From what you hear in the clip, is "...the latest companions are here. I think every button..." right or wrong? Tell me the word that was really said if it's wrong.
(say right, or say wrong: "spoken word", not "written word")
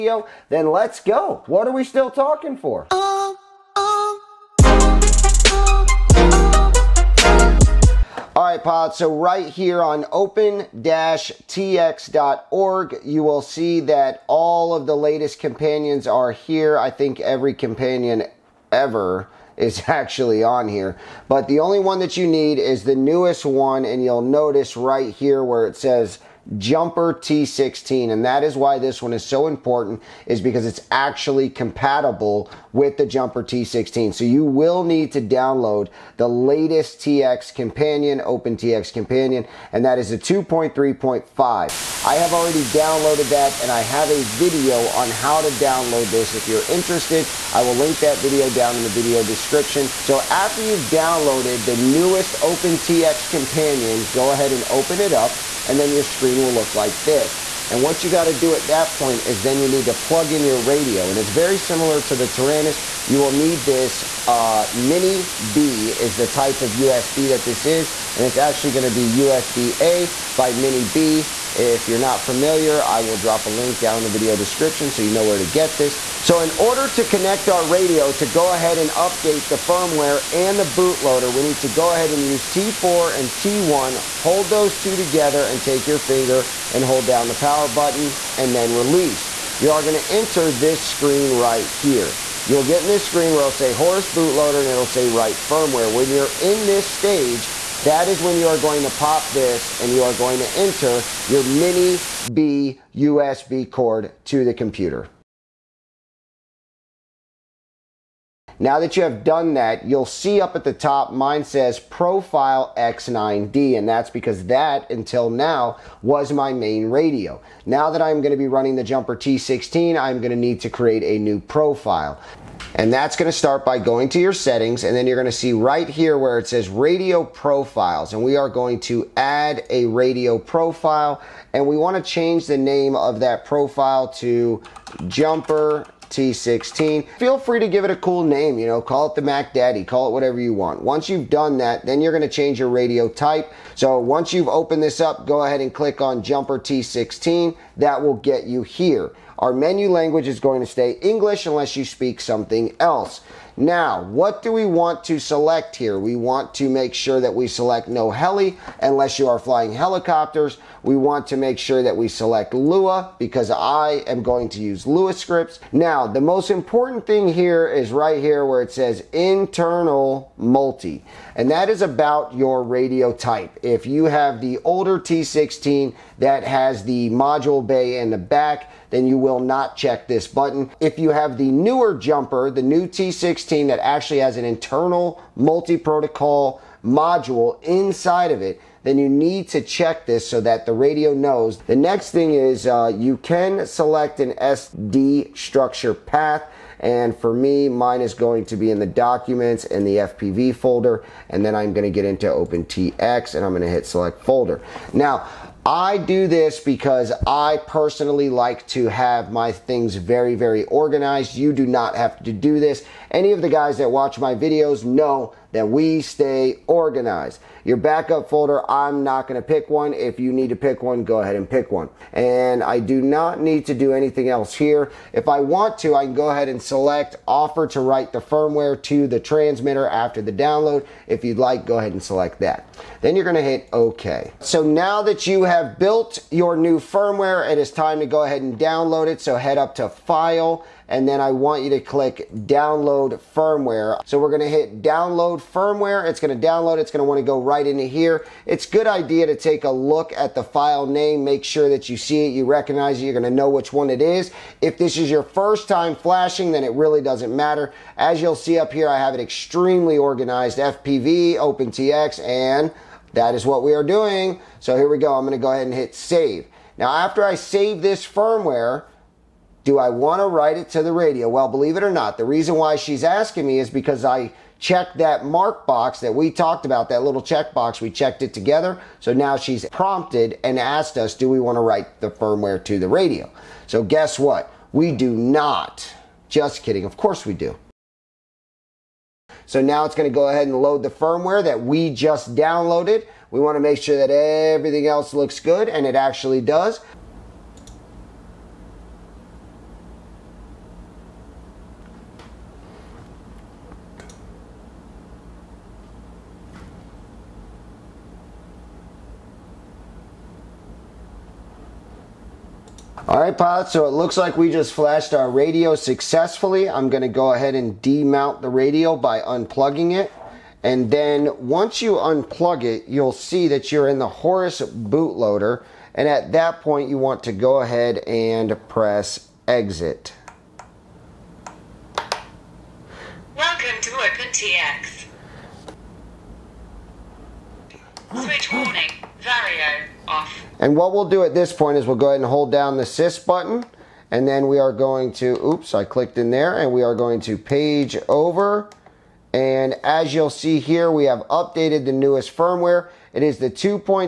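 wrong: "companion", not "button".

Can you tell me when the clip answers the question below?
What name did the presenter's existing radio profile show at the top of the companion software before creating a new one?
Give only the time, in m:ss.
1:51.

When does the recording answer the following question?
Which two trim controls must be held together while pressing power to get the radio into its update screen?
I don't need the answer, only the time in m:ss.
1:22.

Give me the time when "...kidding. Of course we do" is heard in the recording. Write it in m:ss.
4:46.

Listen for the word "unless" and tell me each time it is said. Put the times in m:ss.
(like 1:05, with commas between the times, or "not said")
2:31, 2:38.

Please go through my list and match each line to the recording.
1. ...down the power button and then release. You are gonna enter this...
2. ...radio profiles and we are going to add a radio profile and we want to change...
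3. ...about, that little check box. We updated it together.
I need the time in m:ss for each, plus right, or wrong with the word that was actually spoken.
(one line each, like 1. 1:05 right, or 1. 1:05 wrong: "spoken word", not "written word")
1. 1:27 right
2. 2:06 right
3. 4:36 wrong: "checked", not "updated".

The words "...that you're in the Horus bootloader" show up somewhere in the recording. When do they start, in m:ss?
5:23.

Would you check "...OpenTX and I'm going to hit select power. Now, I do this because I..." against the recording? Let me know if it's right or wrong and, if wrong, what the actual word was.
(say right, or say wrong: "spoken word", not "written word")
wrong: "folder", not "power".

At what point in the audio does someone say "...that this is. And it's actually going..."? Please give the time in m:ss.
1:07.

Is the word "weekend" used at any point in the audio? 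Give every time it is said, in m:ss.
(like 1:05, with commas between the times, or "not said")
not said.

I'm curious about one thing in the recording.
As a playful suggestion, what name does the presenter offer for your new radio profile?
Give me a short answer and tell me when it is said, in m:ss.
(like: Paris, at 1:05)
the Mac Daddy, at 2:19.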